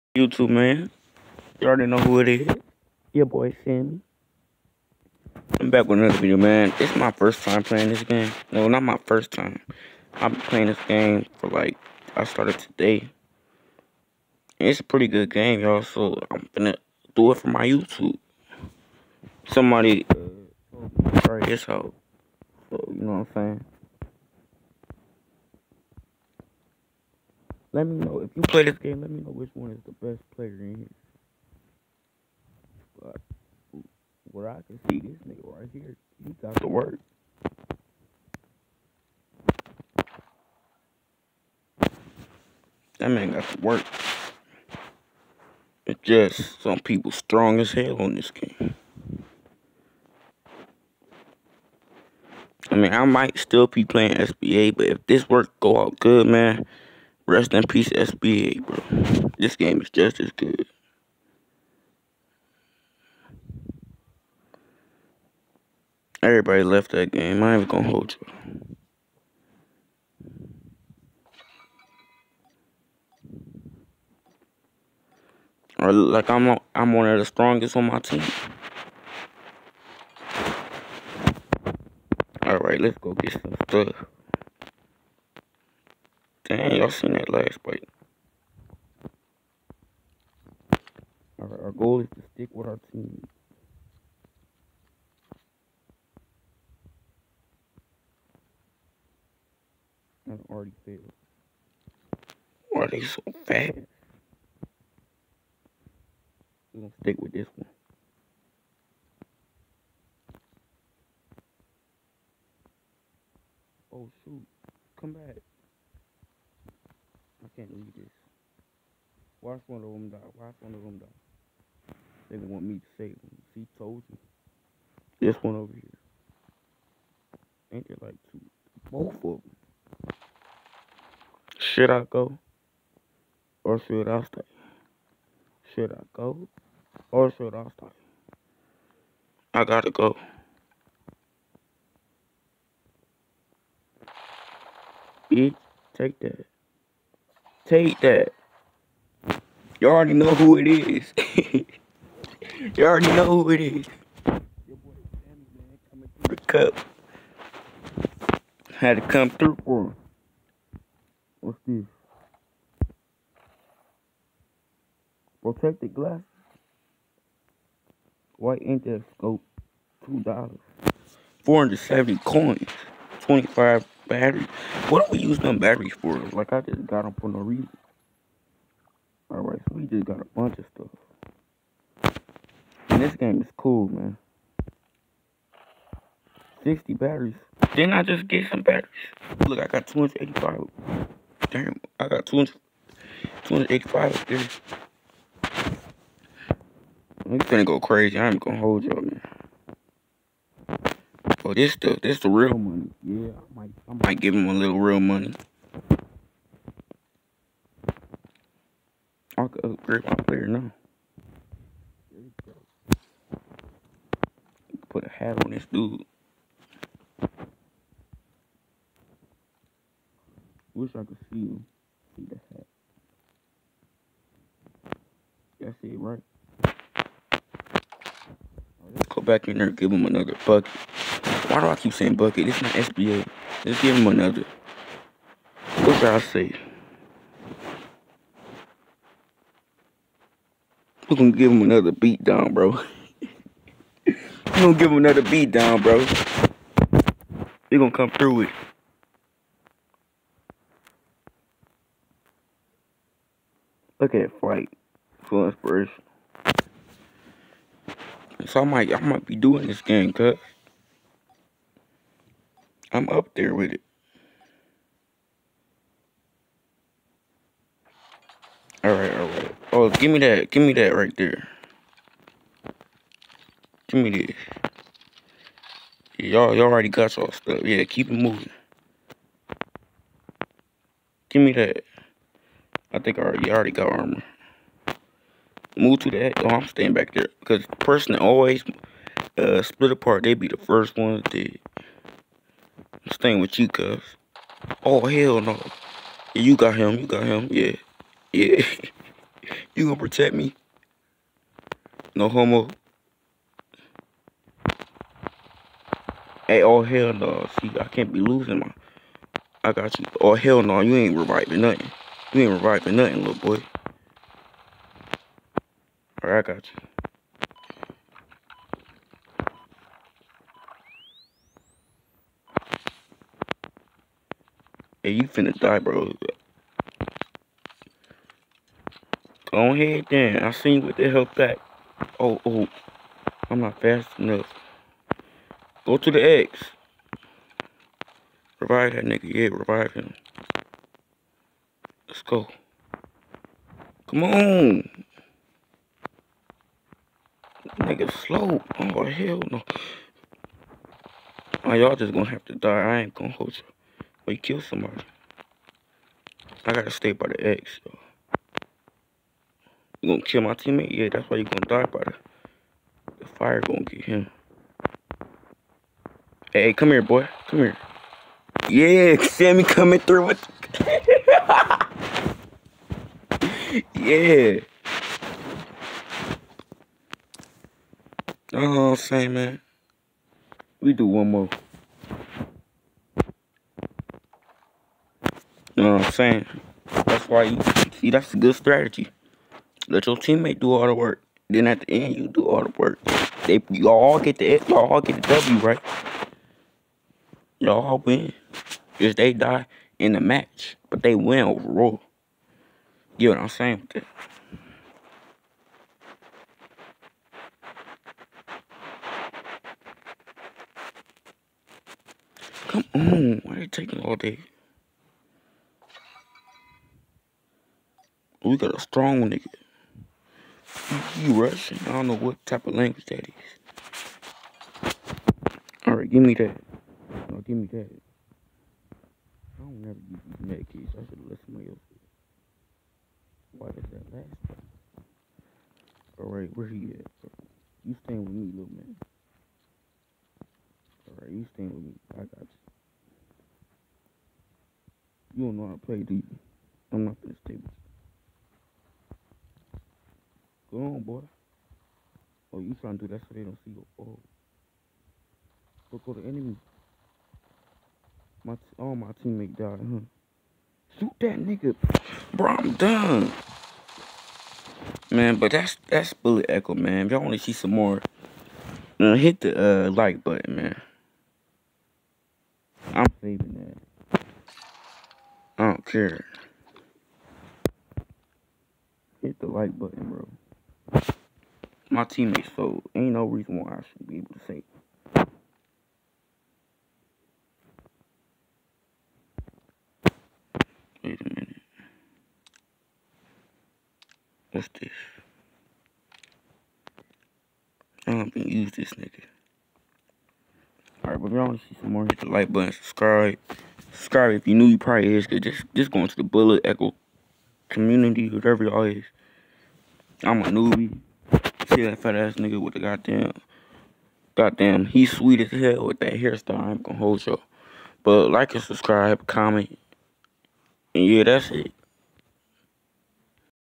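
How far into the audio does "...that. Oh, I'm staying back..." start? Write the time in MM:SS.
04:46.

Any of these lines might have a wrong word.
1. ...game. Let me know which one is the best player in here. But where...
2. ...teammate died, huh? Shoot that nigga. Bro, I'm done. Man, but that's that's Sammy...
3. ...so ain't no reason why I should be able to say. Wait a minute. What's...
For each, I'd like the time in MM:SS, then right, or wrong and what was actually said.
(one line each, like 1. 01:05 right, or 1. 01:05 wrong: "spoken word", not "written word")
1. 00:28 right
2. 07:39 wrong: "Bullet", not "Sammy"
3. 08:02 right.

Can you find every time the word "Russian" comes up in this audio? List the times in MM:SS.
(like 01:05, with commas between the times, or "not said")
07:01.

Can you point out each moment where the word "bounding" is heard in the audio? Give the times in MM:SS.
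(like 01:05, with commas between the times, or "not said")
not said.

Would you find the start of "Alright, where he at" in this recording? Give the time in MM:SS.
07:16.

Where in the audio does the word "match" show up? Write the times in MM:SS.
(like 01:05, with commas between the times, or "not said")
06:40.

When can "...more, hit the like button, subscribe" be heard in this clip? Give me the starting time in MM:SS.
08:21.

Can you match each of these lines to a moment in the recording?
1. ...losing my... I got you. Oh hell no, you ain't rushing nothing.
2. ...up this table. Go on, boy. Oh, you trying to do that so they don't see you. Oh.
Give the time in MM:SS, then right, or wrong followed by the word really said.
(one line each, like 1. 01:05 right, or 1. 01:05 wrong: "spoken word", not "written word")
1. 05:08 wrong: "reviving", not "rushing"
2. 07:27 right.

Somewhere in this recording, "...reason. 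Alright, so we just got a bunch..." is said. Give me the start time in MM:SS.
02:57.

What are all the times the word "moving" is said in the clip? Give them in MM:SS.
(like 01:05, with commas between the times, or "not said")
04:38.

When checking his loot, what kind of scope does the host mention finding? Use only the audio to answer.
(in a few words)
White scope.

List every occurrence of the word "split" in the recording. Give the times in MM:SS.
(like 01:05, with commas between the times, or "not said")
04:49.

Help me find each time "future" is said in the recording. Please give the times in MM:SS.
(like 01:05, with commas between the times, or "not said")
not said.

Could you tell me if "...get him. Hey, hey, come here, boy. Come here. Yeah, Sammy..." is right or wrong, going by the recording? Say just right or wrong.
right.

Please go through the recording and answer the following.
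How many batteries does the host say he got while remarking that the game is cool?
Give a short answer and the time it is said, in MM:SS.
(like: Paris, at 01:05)
60, at 03:06.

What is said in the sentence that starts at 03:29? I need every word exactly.
I could upgrade my player now.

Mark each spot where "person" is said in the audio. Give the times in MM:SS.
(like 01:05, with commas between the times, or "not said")
04:47.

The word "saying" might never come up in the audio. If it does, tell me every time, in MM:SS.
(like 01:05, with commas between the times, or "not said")
00:23, 03:51, 06:18, 06:26, 06:43.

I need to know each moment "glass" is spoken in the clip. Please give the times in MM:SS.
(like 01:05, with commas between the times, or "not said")
02:45.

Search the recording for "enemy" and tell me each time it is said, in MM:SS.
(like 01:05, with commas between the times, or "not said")
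07:36.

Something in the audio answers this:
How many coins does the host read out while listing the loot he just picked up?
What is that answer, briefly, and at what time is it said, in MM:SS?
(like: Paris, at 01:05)
470, at 02:51.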